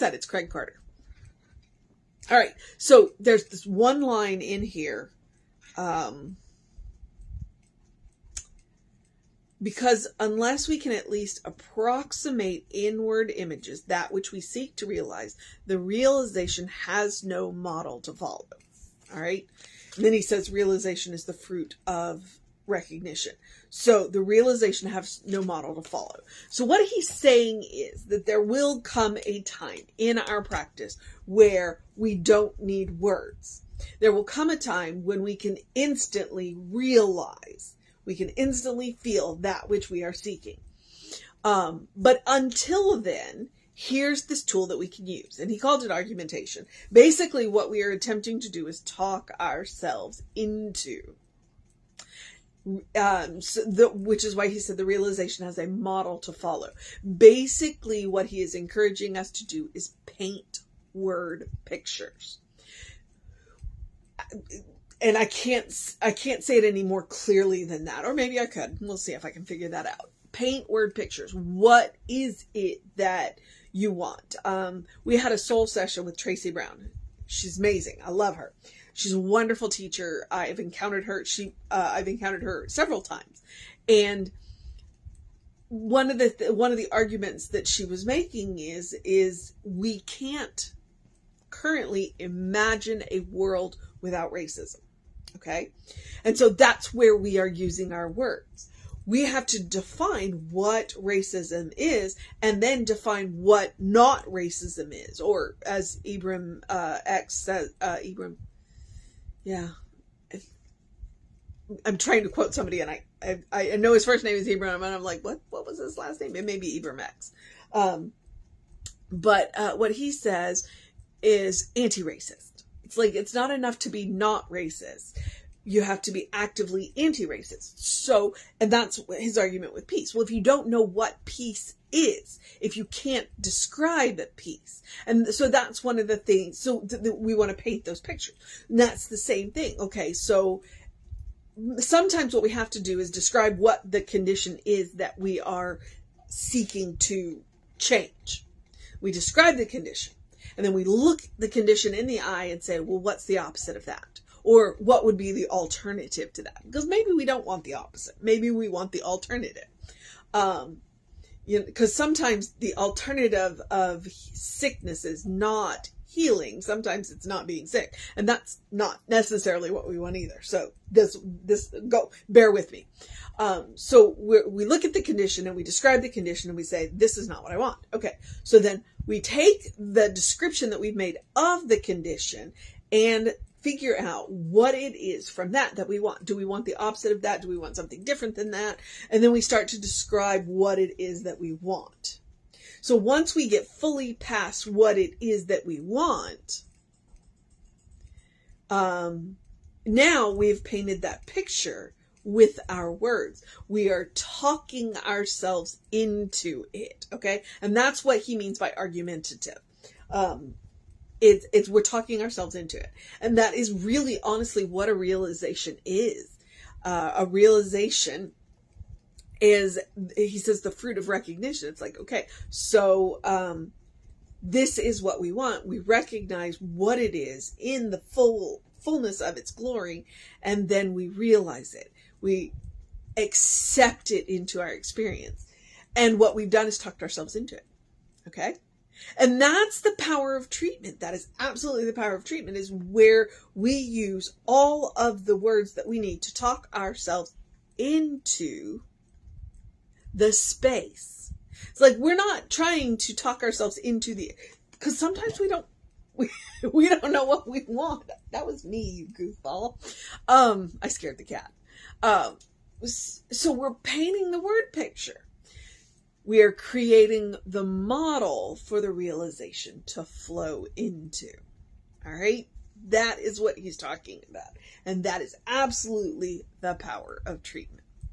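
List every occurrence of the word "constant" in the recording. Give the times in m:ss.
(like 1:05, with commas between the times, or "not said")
not said.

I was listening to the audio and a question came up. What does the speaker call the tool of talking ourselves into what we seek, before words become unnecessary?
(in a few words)
Argumentation.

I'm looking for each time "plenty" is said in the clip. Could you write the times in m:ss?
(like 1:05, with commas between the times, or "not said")
not said.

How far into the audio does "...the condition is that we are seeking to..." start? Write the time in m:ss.
2:23.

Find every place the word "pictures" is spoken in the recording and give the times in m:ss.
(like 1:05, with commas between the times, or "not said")
1:01, 1:10, 2:17, 3:21, 4:24.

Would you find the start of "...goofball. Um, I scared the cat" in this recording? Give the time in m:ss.
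4:19.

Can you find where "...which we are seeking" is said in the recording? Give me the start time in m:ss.
0:39.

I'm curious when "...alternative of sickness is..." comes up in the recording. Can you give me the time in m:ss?
2:42.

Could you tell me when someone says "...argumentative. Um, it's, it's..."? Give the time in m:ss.
3:28.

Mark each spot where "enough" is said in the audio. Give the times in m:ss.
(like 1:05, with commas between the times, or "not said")
2:03.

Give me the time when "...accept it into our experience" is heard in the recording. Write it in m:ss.
3:53.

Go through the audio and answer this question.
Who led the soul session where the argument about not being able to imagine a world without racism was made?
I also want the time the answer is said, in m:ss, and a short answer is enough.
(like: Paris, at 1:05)
Tracy Brown, at 1:16.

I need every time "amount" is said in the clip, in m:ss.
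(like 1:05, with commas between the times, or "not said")
not said.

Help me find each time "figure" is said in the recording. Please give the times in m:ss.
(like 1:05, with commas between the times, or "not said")
1:09, 3:03.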